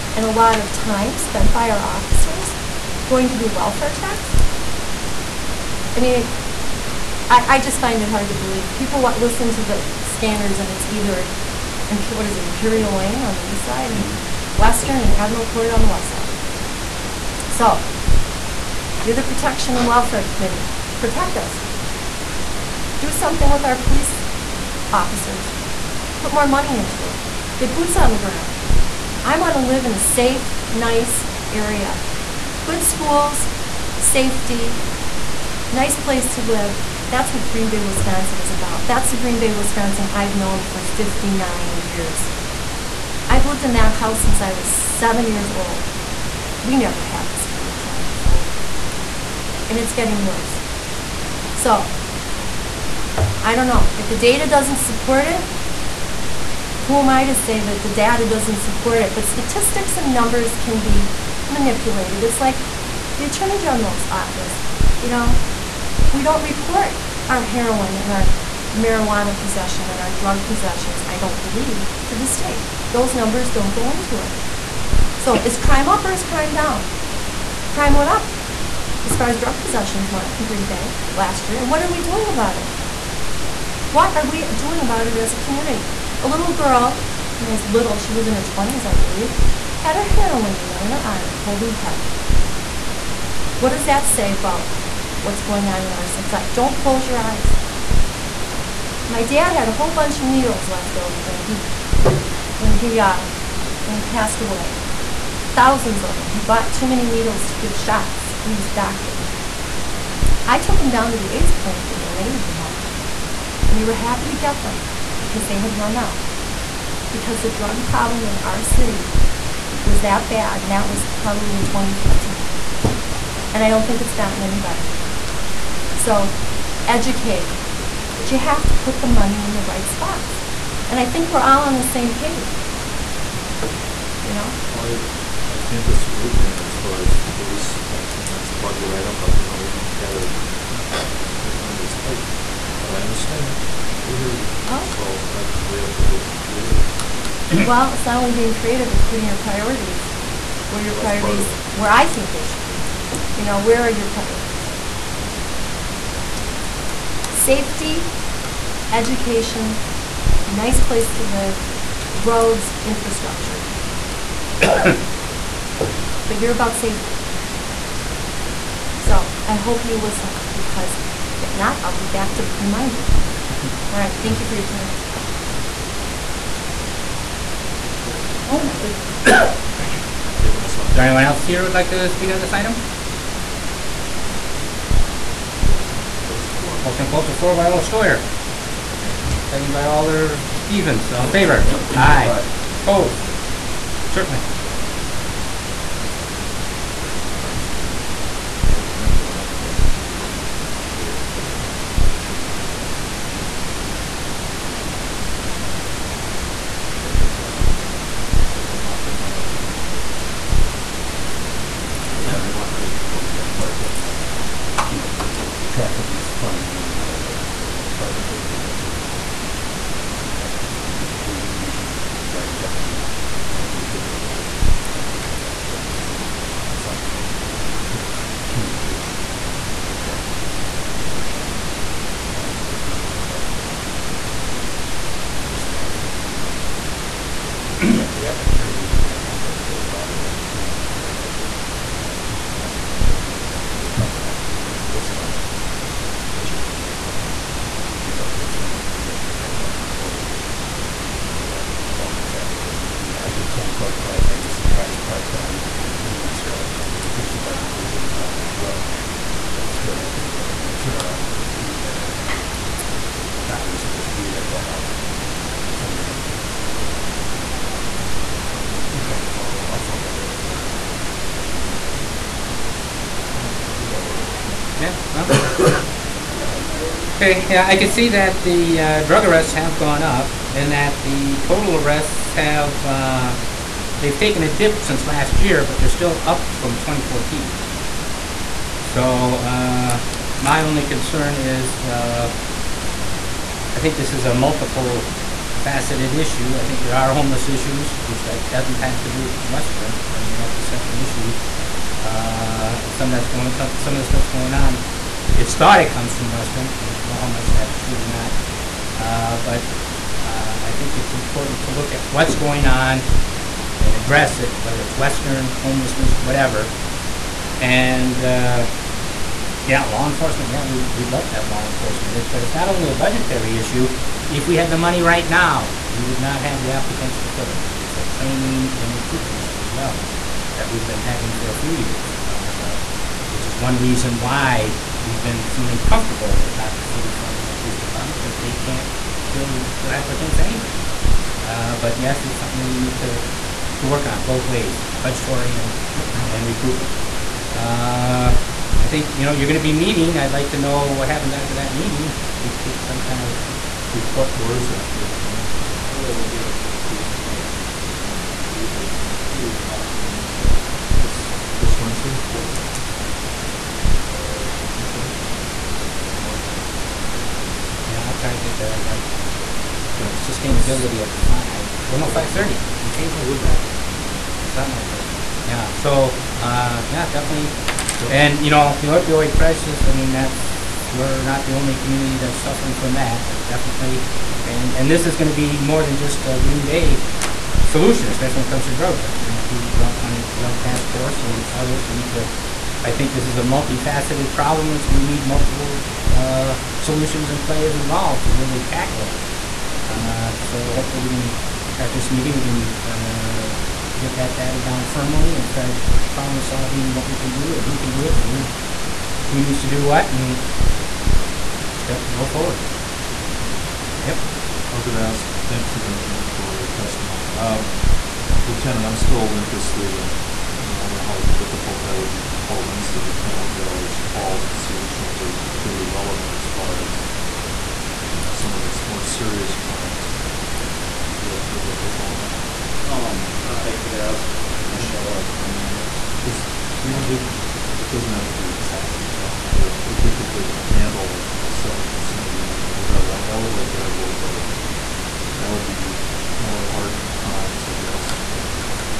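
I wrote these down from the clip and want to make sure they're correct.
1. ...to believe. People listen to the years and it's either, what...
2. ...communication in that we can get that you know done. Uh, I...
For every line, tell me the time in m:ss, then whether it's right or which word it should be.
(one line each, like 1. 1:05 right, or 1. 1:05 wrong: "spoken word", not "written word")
1. 0:08 wrong: "scanners", not "years"
2. 3:48 right.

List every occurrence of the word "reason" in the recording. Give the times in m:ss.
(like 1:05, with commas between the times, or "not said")
5:33.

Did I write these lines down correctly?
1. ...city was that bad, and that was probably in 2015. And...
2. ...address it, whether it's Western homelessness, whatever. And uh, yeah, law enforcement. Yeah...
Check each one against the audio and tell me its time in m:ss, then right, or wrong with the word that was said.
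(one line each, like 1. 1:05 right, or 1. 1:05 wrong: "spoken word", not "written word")
1. 1:58 right
2. 5:13 right.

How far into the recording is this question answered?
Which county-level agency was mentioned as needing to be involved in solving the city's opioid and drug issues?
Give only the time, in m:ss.
6:29.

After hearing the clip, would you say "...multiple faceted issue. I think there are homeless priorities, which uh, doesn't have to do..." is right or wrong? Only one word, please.
wrong.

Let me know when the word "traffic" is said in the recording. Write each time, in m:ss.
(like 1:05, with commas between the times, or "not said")
3:35, 4:12.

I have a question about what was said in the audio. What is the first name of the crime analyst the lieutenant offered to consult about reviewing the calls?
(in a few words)
Michelle.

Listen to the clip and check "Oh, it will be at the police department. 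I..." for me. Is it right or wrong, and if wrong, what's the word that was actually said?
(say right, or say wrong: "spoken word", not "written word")
right.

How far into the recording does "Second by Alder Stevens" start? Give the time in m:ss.
3:09.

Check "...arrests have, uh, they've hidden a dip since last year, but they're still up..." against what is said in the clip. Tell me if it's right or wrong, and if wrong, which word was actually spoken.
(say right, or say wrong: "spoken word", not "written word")
wrong: "taken", not "hidden".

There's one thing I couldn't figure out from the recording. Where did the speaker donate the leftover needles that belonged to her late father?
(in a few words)
AIDS clinic.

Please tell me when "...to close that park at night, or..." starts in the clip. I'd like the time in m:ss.
3:32.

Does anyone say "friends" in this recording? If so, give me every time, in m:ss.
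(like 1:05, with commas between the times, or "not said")
not said.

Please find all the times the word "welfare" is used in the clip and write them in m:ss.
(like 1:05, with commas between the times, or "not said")
0:03, 0:19.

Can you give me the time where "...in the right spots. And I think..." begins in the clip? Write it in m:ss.
2:09.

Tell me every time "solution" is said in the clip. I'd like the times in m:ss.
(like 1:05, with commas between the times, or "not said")
6:27, 6:36.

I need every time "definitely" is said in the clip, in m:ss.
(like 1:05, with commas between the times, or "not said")
6:17, 6:23.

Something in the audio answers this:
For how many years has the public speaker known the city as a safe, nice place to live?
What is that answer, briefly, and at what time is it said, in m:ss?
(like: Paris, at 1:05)
59, at 0:40.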